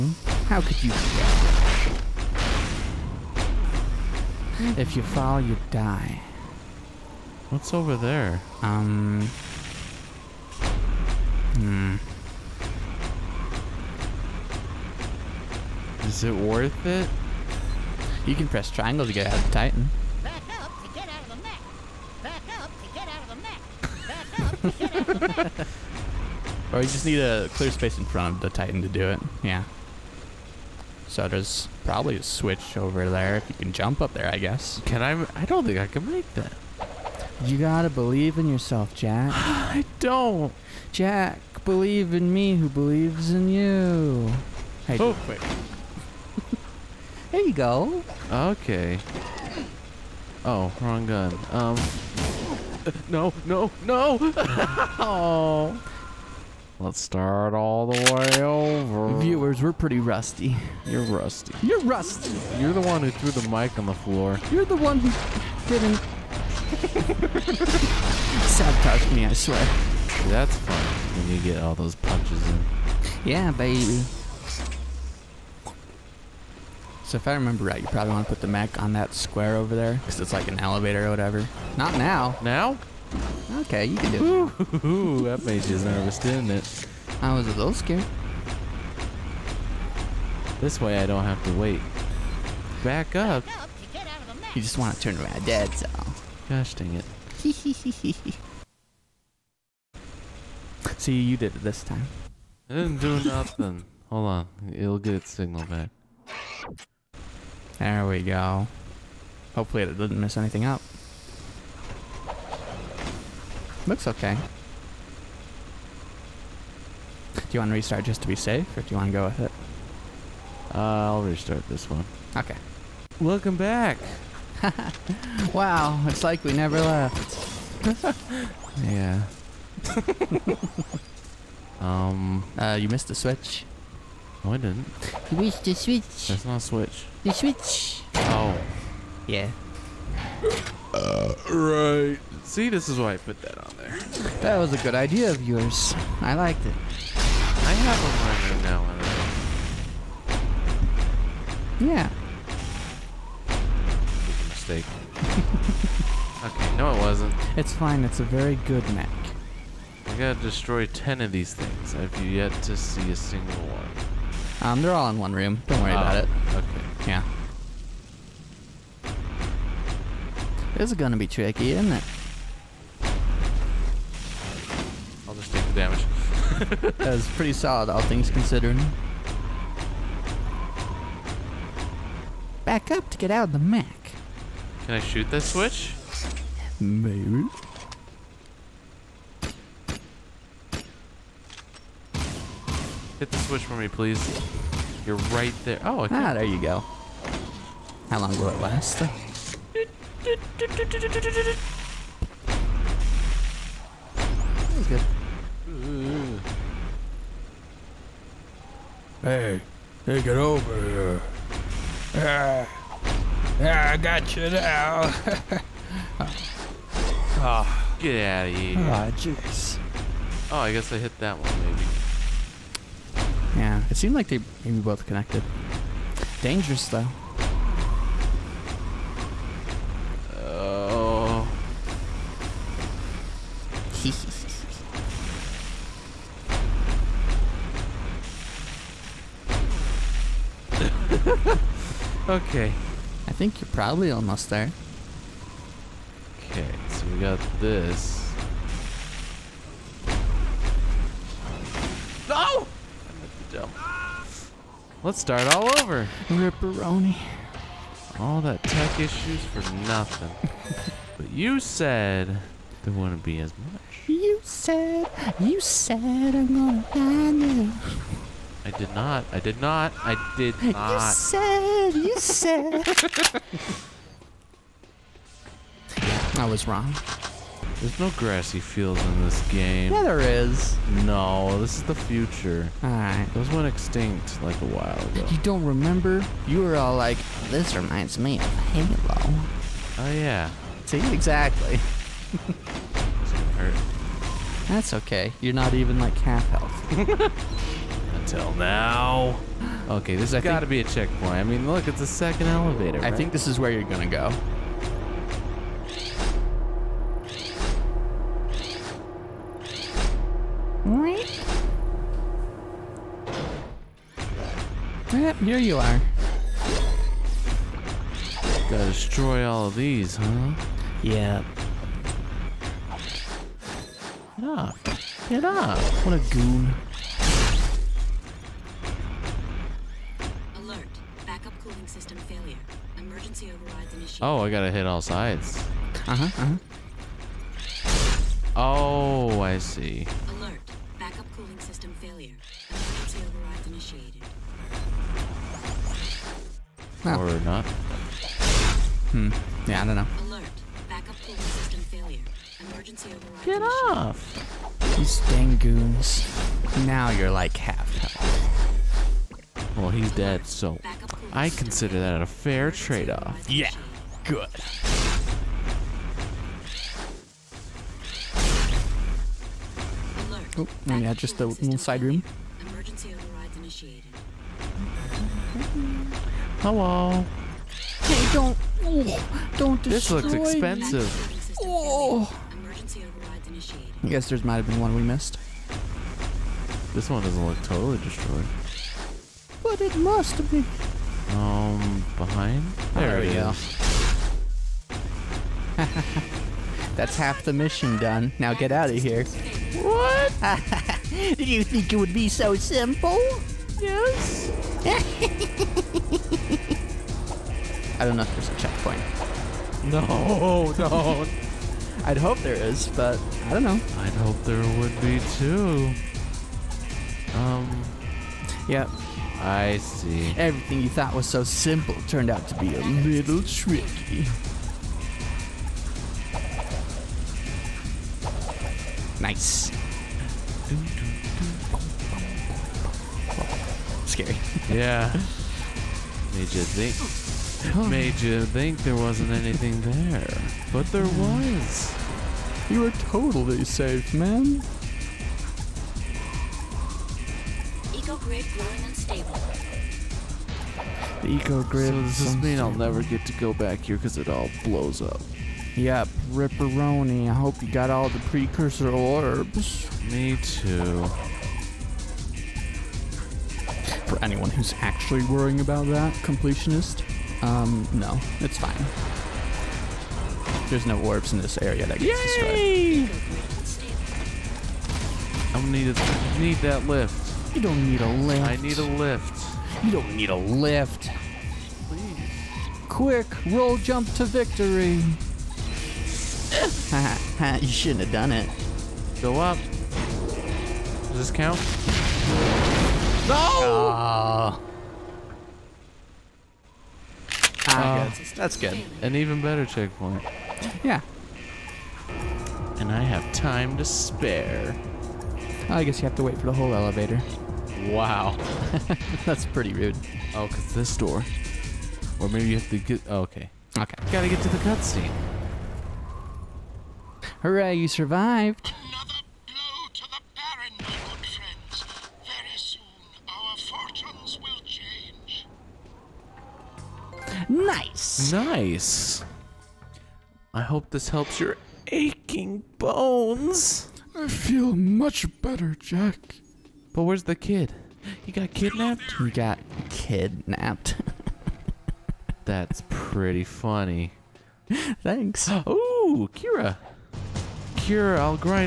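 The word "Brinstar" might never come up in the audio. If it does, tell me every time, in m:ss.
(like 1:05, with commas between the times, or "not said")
not said.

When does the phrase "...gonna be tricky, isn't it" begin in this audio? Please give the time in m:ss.
2:50.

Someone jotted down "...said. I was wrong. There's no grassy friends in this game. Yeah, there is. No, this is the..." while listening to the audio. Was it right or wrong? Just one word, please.
wrong.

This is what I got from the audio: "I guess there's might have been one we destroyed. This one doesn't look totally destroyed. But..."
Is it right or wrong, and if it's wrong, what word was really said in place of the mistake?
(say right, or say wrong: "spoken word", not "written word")
wrong: "missed", not "destroyed".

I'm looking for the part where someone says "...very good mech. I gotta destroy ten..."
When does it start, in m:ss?
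2:38.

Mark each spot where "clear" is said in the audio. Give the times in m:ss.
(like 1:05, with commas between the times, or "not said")
0:27.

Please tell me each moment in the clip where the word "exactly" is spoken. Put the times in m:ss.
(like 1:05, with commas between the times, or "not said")
4:51.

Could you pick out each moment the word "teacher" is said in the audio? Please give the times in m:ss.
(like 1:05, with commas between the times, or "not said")
not said.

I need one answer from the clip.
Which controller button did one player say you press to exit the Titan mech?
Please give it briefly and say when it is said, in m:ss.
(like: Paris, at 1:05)
Triangle, at 0:18.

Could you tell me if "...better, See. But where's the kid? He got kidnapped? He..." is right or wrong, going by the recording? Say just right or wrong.
wrong.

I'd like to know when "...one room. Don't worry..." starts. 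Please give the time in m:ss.
2:45.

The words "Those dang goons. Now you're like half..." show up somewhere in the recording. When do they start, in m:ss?
5:55.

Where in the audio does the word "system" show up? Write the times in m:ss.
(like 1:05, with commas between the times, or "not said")
5:31, 5:41, 5:51.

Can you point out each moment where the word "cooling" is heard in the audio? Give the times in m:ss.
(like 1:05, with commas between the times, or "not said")
5:31, 5:41, 5:51.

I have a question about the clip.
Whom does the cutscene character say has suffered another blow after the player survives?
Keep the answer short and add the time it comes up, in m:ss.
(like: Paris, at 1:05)
The Baron, at 8:40.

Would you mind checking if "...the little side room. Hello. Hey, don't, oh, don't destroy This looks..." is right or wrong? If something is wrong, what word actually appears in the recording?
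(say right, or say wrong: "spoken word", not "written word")
right.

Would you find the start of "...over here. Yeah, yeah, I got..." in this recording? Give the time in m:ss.
3:30.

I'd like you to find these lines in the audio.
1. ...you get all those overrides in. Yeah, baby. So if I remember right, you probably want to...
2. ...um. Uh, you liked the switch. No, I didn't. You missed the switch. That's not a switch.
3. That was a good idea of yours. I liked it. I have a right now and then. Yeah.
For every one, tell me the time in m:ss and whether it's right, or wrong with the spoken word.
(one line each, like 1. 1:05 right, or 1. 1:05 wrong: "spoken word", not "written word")
1. 1:11 wrong: "punches", not "overrides"
2. 2:11 wrong: "missed", not "liked"
3. 2:24 right.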